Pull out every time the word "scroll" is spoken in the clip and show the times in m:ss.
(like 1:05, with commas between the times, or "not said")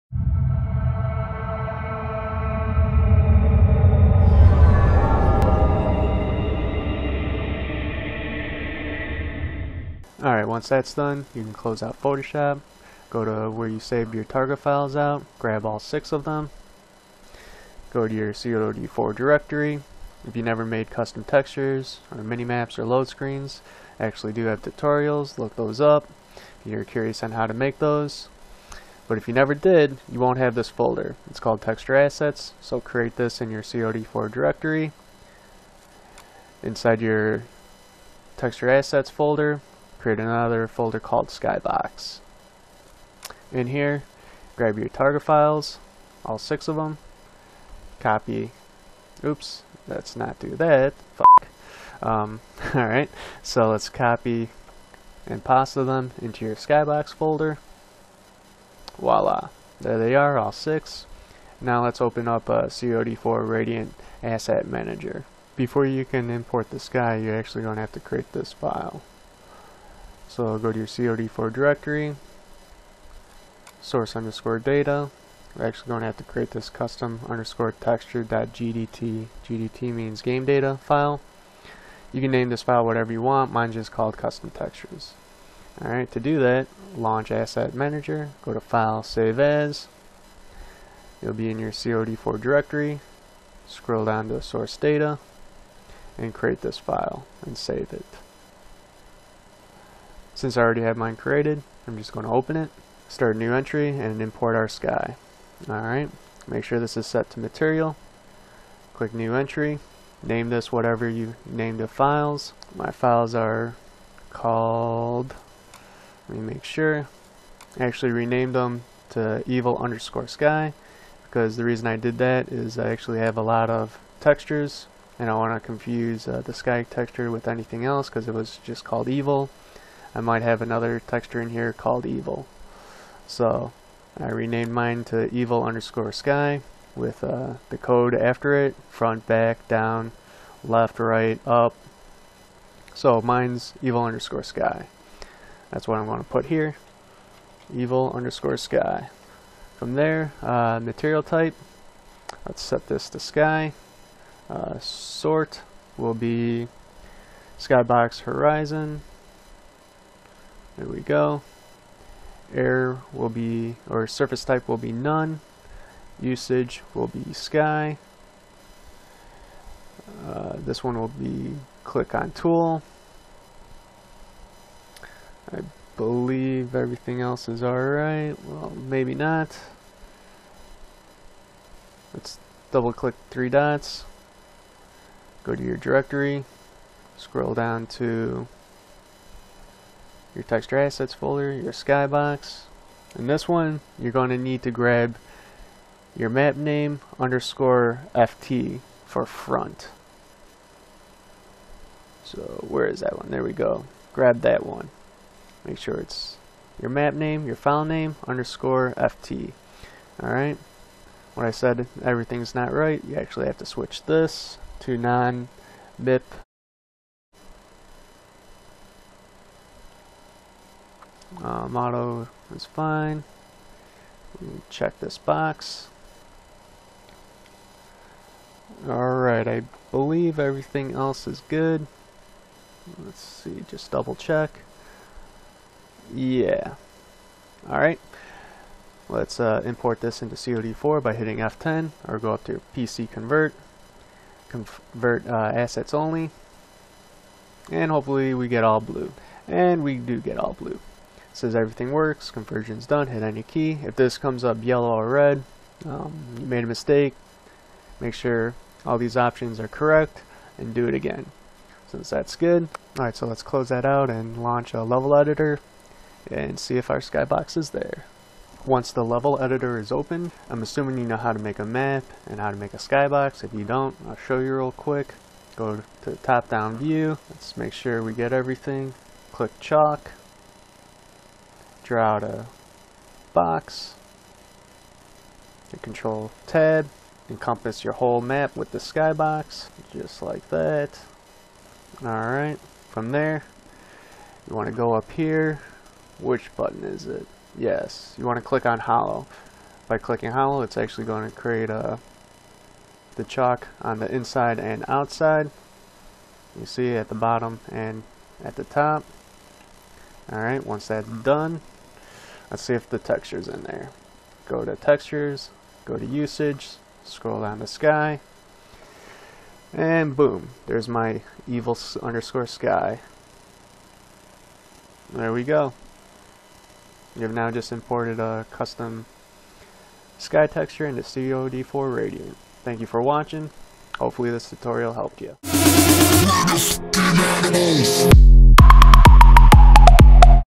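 1:33, 3:07, 5:17.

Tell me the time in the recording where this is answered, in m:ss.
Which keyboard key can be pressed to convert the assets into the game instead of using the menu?
4:01.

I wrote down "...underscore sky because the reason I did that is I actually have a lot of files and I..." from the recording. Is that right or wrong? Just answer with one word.
wrong.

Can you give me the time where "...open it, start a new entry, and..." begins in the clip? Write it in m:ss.
1:42.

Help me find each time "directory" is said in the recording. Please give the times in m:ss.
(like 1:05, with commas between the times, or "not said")
0:19, 0:34, 1:11, 1:32, 3:05.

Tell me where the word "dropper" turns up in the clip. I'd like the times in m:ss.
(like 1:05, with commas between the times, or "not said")
not said.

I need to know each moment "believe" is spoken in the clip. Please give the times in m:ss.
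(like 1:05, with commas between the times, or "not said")
2:55, 3:49.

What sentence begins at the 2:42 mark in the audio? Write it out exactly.
Air will be, or surface type will be none.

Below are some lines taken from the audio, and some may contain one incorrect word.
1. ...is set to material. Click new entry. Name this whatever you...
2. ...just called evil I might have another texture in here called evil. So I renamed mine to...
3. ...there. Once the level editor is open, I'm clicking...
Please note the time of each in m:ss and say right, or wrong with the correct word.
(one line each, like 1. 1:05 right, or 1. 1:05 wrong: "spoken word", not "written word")
1. 1:46 right
2. 2:08 right
3. 4:27 wrong: "assuming", not "clicking".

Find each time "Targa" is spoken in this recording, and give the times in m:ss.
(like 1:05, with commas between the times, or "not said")
0:14, 0:44.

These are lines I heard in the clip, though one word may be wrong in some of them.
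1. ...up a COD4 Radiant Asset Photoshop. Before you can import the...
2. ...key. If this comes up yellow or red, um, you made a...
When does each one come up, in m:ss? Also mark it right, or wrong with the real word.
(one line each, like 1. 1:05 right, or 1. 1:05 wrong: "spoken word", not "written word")
1. 1:02 wrong: "Manager", not "Photoshop"
2. 4:13 right.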